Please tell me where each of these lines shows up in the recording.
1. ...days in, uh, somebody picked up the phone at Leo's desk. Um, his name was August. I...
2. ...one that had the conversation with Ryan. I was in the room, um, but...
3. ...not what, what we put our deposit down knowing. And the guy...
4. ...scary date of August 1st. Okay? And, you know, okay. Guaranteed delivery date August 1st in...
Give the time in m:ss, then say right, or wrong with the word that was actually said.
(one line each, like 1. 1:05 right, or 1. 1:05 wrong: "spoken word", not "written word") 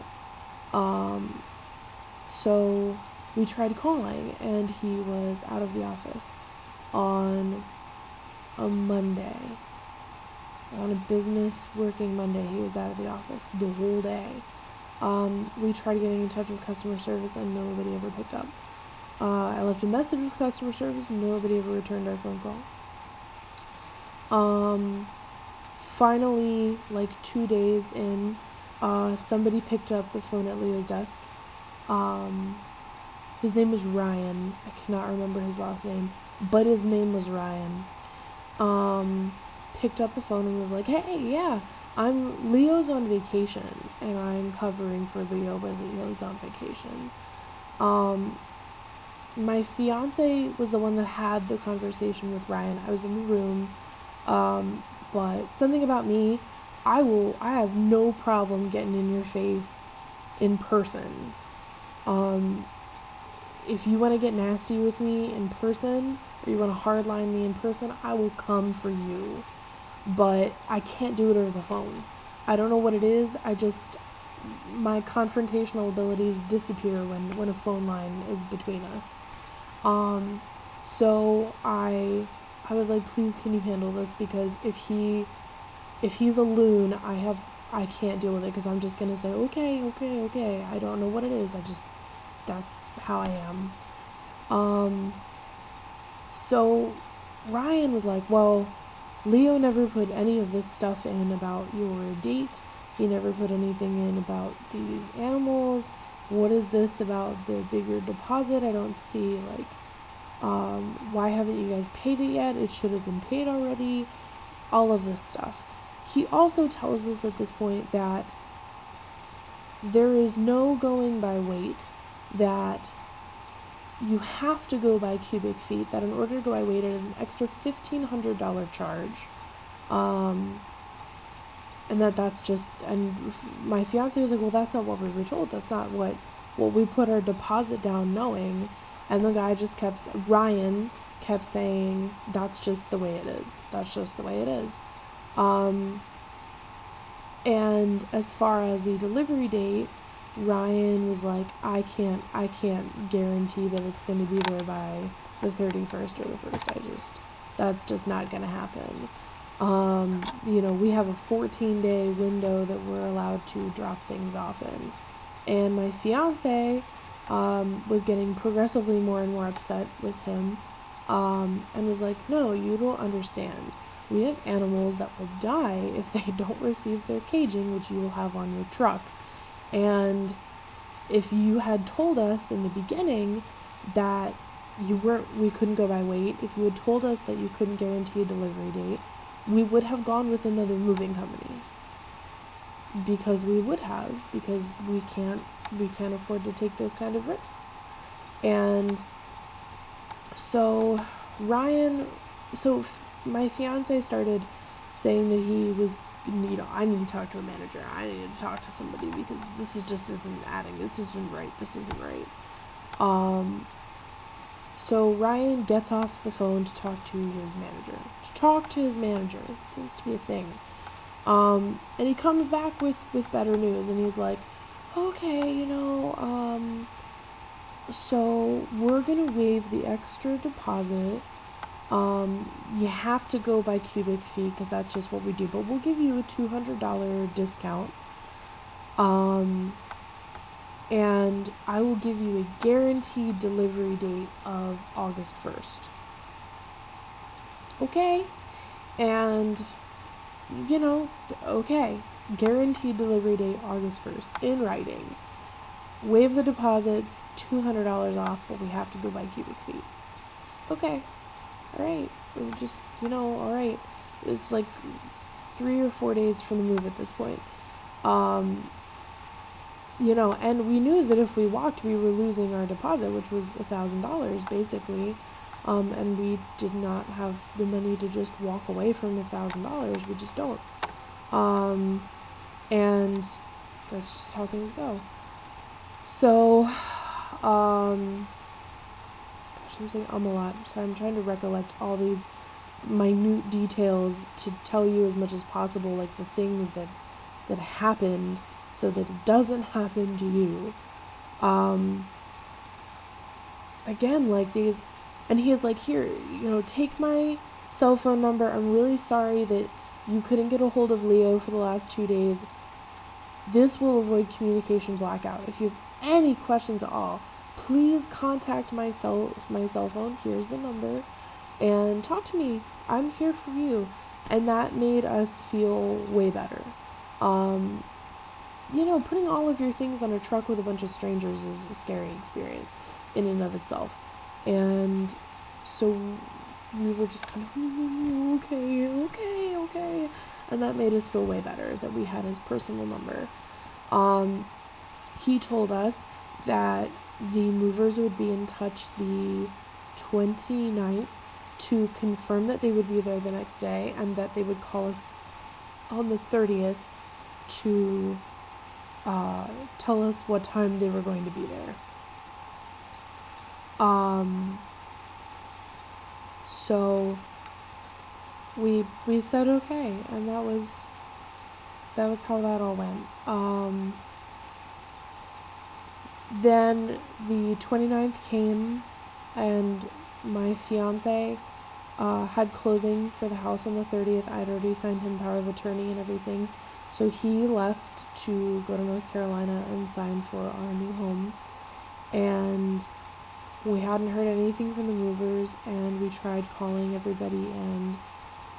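1. 0:27 wrong: "Ryan", not "August"
2. 0:50 right
3. 2:15 right
4. 4:03 wrong: "delivery", not "scary".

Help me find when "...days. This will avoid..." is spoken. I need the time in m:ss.
5:12.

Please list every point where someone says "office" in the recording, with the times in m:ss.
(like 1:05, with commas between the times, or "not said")
0:05, 0:13.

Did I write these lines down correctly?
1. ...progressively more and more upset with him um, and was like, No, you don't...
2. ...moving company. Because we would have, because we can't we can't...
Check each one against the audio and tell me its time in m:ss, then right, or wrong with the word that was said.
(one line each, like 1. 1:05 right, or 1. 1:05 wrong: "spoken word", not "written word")
1. 2:48 right
2. 3:10 right.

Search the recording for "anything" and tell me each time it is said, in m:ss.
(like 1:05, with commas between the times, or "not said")
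1:43, 6:34.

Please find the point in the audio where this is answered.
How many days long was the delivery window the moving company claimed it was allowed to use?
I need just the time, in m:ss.
2:41.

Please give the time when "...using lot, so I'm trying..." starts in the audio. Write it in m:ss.
4:49.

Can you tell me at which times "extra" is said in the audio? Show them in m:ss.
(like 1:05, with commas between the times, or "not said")
2:07, 3:49.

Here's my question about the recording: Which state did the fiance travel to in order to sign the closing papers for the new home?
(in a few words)
North Carolina.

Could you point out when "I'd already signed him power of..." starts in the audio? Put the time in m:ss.
6:24.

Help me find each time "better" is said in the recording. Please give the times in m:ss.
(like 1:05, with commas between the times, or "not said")
3:43, 5:26, 5:41.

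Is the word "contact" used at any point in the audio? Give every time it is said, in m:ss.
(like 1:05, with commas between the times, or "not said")
5:18.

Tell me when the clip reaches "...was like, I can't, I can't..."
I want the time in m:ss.
2:31.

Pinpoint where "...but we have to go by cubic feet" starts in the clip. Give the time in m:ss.
4:18.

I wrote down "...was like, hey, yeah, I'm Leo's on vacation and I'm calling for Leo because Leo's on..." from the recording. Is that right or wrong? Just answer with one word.
wrong.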